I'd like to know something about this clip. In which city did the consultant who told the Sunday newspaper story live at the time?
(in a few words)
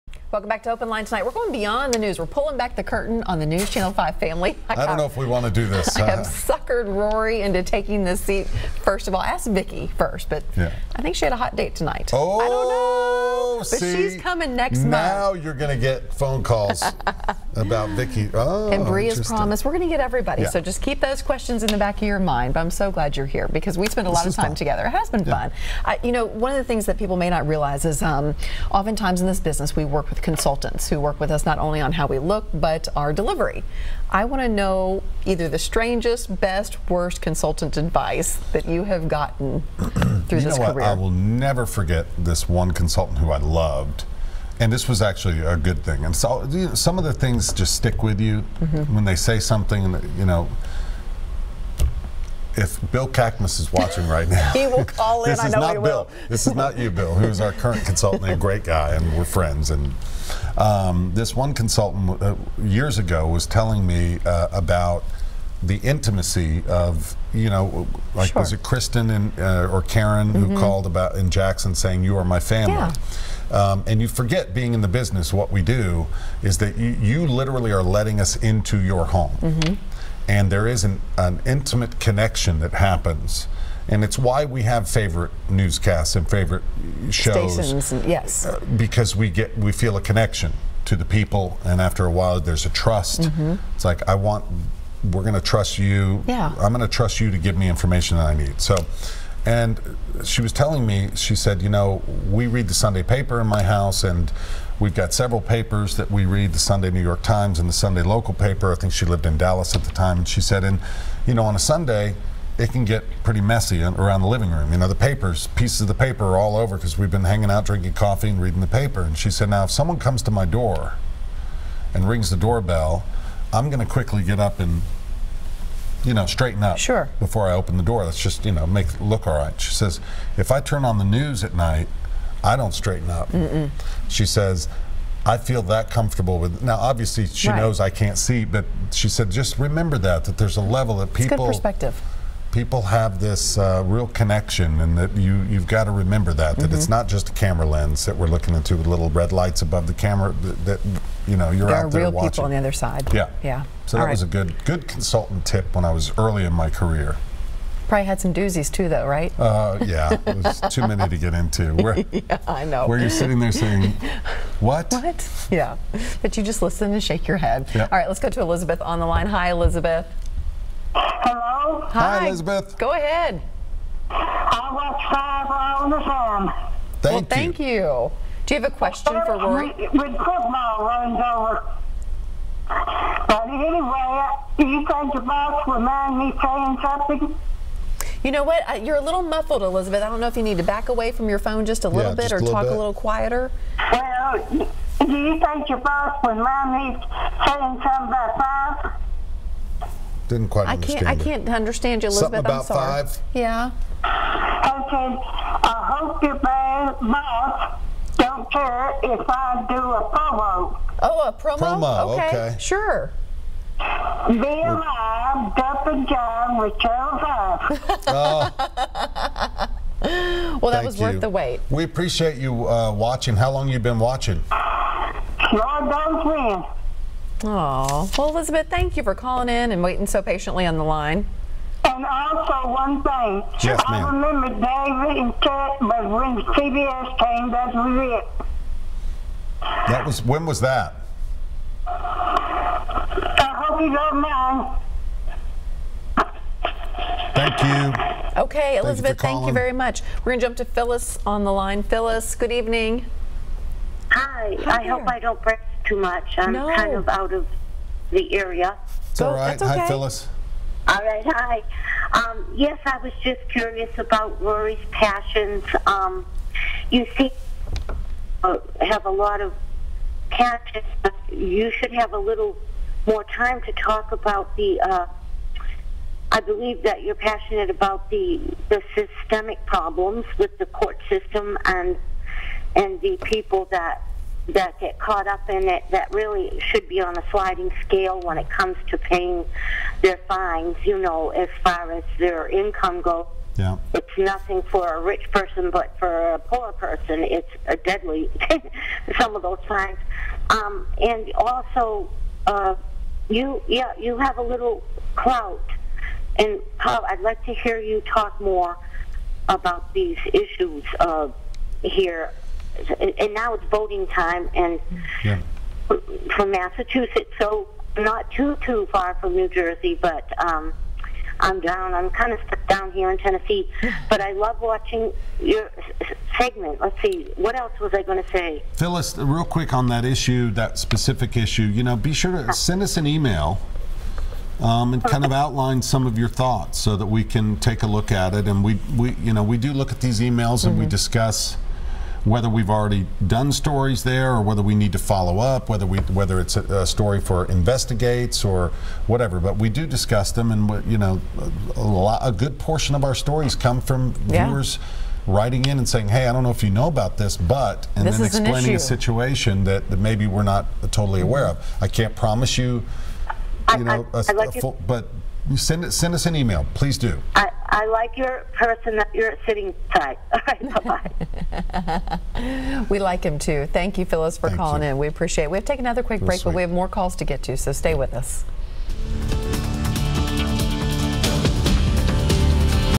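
Dallas.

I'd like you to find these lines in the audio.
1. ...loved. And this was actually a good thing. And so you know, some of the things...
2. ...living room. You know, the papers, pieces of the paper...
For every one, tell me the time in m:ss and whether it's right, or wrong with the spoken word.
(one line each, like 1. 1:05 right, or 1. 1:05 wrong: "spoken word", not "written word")
1. 0:43 right
2. 1:54 right.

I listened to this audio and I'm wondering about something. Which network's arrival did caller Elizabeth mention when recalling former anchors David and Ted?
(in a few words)
CBS.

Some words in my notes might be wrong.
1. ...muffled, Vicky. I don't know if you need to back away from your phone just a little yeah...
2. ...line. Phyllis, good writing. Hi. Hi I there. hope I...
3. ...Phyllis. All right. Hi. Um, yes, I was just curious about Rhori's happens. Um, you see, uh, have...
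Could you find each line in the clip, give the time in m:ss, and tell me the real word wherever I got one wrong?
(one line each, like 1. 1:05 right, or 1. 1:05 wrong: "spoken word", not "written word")
1. 3:09 wrong: "Elizabeth", not "Vicky"
2. 4:11 wrong: "evening", not "writing"
3. 4:19 wrong: "passions", not "happens".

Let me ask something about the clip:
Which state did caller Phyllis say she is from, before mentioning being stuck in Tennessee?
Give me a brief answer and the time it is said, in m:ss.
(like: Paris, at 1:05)
Massachusetts, at 5:16.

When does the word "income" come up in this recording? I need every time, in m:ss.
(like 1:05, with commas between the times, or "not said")
4:52.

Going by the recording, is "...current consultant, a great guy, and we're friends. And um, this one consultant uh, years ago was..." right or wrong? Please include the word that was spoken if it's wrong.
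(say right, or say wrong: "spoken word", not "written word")
right.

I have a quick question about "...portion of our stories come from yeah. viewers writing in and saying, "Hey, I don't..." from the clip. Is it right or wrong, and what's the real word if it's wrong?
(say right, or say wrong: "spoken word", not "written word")
right.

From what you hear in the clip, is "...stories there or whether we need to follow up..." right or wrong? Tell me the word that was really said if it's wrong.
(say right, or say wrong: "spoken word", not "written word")
right.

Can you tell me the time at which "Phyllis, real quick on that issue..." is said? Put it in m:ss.
5:28.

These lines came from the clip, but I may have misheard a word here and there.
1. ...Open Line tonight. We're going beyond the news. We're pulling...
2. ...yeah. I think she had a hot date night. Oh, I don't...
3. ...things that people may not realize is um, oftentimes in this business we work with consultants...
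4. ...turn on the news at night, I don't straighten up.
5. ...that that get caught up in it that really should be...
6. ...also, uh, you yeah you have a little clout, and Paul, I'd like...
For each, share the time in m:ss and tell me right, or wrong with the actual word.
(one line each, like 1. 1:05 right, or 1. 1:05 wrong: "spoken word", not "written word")
1. 0:00 right
2. 0:10 wrong: "tonight", not "night"
3. 0:26 right
4. 2:10 right
5. 4:43 right
6. 5:01 right.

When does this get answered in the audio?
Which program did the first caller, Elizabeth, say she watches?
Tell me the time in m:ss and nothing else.
2:55.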